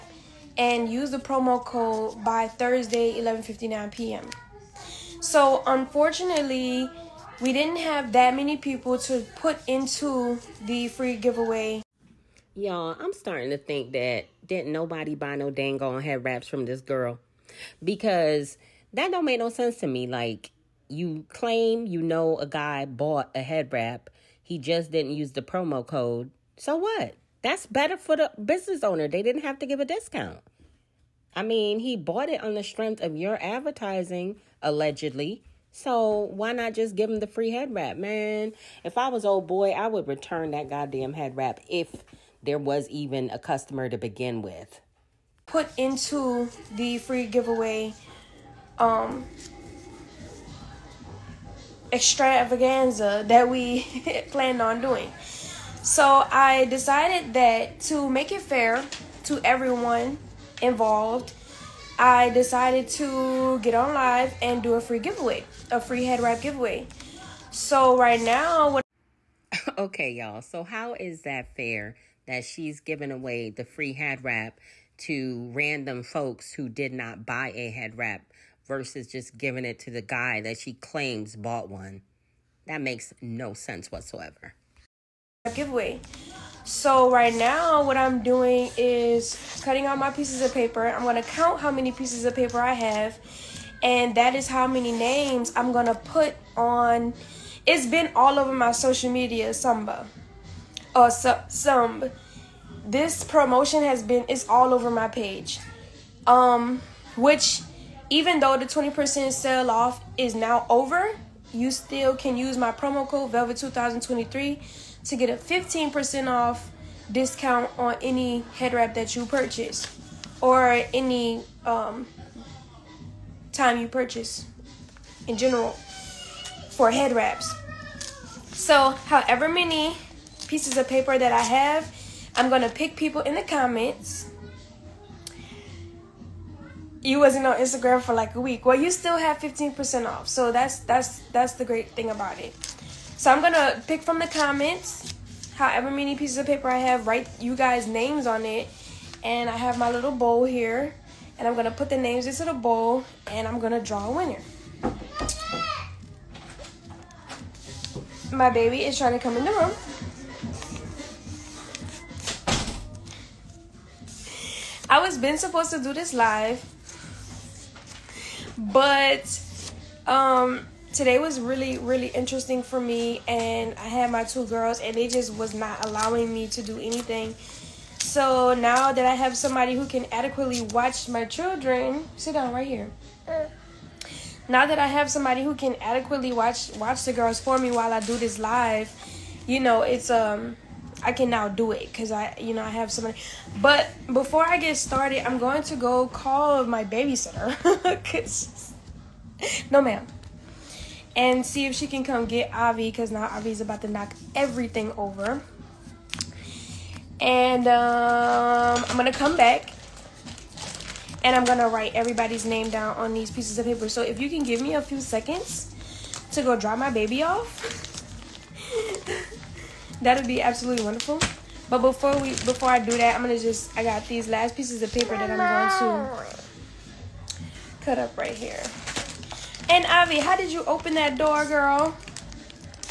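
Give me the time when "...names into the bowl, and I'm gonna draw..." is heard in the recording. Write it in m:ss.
2:31.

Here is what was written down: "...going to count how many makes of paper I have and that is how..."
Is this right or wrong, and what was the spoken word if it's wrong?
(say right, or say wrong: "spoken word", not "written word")
wrong: "pieces", not "makes".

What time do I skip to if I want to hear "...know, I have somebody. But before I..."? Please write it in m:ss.
3:12.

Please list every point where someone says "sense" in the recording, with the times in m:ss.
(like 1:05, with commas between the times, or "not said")
0:19, 1:23.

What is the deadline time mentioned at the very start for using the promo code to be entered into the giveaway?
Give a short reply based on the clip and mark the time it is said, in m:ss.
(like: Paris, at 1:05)
Thursday 11:59 p.m., at 0:02.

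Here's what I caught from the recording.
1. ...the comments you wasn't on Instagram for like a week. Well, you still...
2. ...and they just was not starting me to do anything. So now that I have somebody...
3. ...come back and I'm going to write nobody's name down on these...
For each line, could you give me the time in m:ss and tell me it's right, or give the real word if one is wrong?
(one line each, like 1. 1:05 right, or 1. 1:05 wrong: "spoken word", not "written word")
1. 2:13 right
2. 2:54 wrong: "allowing", not "starting"
3. 3:29 wrong: "everybody", not "nobody".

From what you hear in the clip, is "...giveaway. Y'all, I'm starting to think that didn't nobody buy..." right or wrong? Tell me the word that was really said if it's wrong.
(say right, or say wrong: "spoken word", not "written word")
right.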